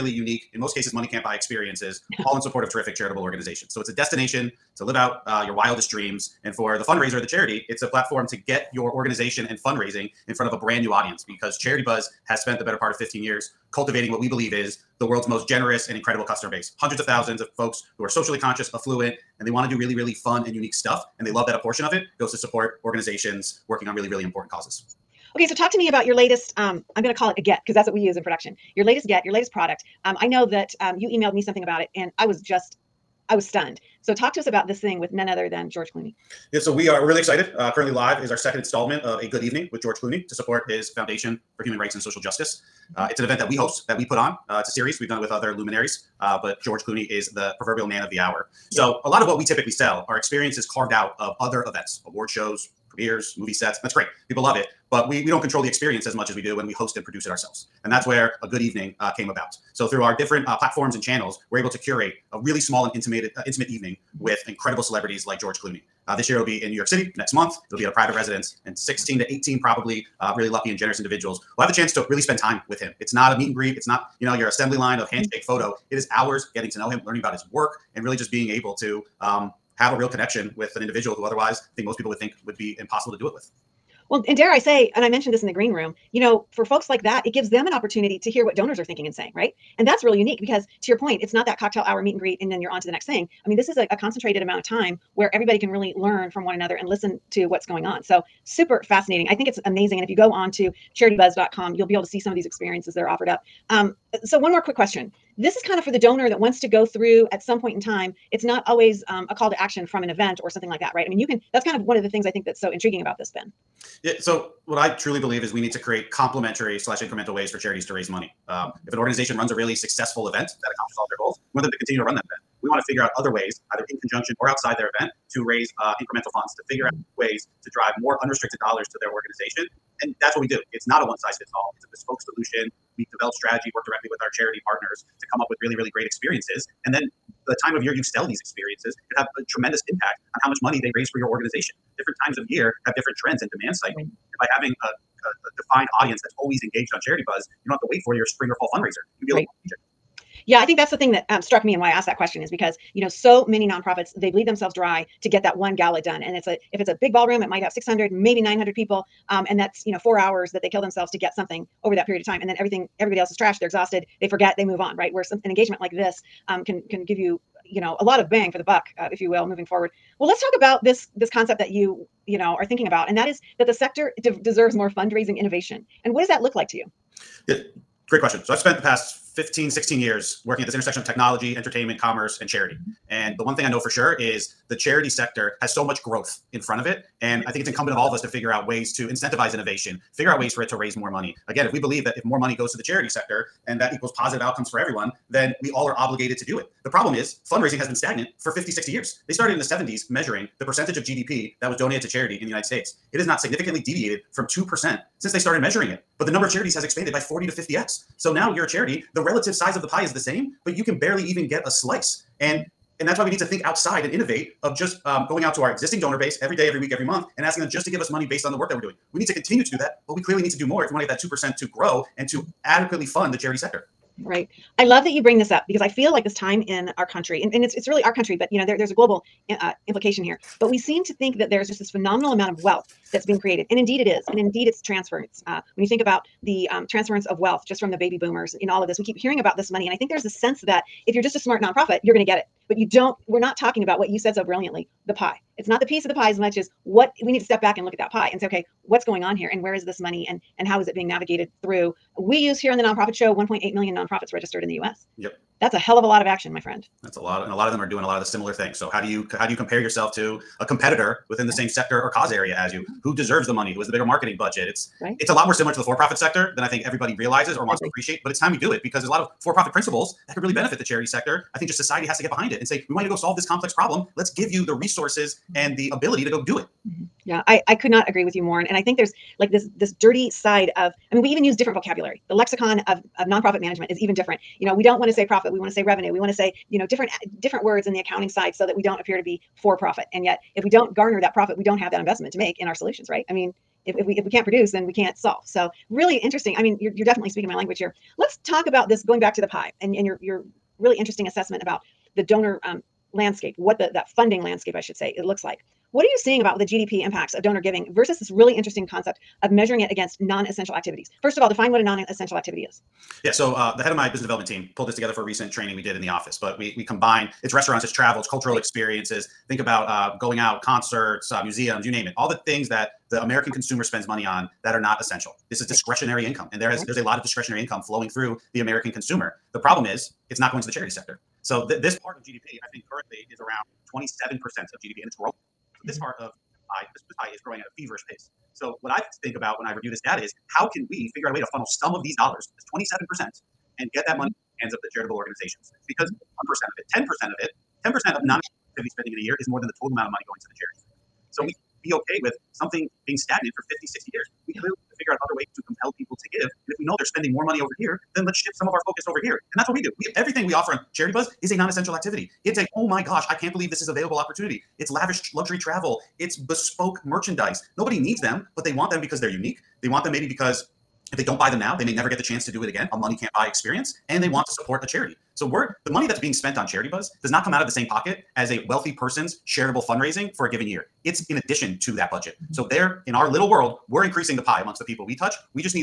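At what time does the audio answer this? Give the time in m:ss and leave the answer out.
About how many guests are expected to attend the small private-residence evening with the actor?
1:08.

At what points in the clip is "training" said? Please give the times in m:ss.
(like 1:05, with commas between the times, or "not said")
5:15.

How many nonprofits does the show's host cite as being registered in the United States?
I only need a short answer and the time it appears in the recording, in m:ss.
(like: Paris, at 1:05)
1.8 million, at 4:13.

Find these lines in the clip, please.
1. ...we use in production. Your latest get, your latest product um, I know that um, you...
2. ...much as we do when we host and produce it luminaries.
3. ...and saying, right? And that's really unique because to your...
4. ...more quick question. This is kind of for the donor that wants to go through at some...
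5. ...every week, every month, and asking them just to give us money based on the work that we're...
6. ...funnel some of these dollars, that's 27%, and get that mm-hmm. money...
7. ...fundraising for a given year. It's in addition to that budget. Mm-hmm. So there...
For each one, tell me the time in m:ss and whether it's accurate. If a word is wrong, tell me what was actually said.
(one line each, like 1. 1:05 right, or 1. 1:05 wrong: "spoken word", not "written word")
1. 0:27 right
2. 0:56 wrong: "ourselves", not "luminaries"
3. 1:29 right
4. 1:44 right
5. 3:36 right
6. 5:41 right
7. 6:19 right.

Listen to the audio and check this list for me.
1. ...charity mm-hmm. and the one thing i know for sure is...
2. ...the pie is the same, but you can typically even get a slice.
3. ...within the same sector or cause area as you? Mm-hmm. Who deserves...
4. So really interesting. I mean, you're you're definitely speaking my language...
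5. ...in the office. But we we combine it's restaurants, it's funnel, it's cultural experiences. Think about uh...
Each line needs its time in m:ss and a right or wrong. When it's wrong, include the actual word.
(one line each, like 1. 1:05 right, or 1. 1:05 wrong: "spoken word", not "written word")
1. 3:02 right
2. 3:29 wrong: "barely", not "typically"
3. 4:21 right
4. 4:55 right
5. 5:15 wrong: "travel", not "funnel".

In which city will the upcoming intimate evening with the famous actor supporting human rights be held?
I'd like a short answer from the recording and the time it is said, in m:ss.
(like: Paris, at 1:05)
New York City, at 1:06.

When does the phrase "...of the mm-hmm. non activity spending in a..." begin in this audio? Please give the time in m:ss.
5:47.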